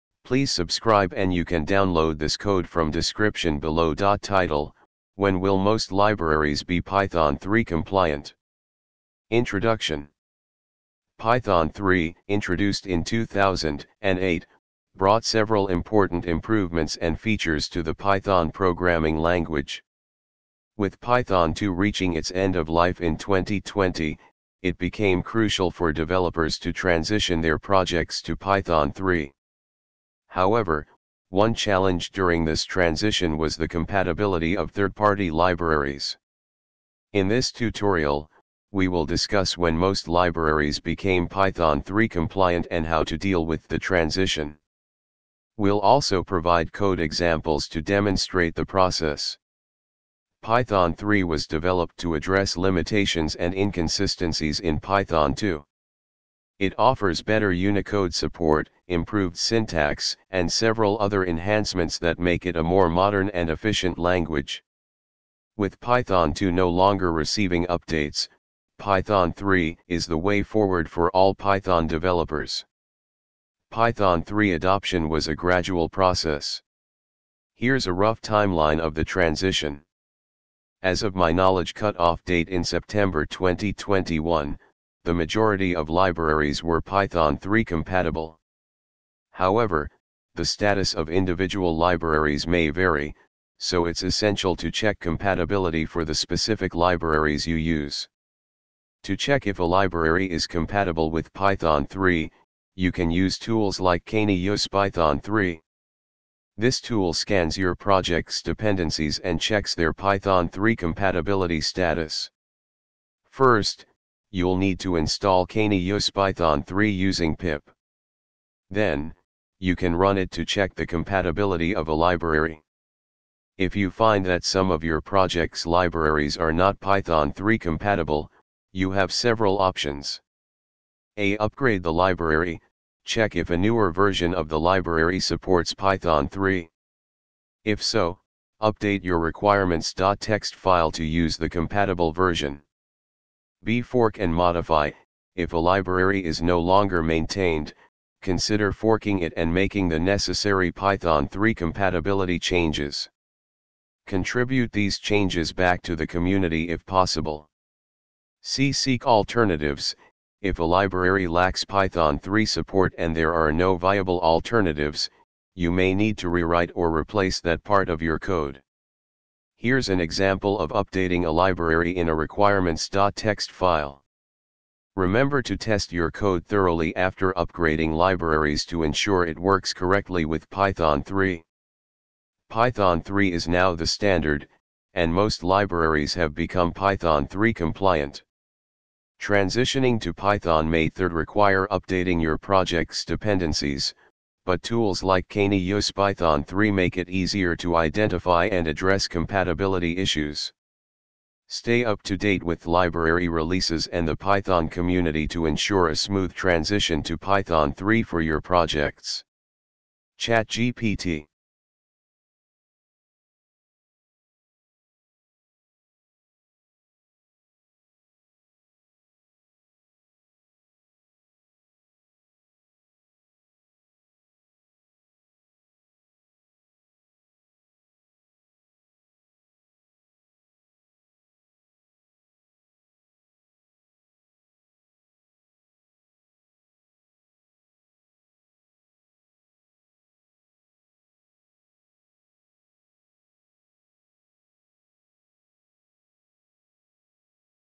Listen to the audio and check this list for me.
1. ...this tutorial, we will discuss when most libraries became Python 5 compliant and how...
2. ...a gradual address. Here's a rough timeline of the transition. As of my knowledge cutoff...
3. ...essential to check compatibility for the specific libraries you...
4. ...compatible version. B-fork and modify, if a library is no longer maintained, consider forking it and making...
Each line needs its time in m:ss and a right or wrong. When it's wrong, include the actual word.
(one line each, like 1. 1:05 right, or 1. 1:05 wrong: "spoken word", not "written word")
1. 0:37 wrong: "3", not "5"
2. 1:15 wrong: "process", not "address"
3. 1:34 right
4. 2:21 right.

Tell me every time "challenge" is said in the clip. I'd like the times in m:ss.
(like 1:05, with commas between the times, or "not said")
0:31.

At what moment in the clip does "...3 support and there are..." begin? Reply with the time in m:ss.
2:42.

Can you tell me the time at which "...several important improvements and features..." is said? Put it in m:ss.
0:15.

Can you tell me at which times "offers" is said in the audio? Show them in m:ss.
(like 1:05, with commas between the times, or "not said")
0:56.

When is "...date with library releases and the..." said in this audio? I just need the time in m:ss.
3:22.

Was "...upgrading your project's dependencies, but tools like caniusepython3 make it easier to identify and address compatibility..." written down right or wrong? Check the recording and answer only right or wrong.
wrong.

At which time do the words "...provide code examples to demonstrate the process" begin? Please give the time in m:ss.
0:46.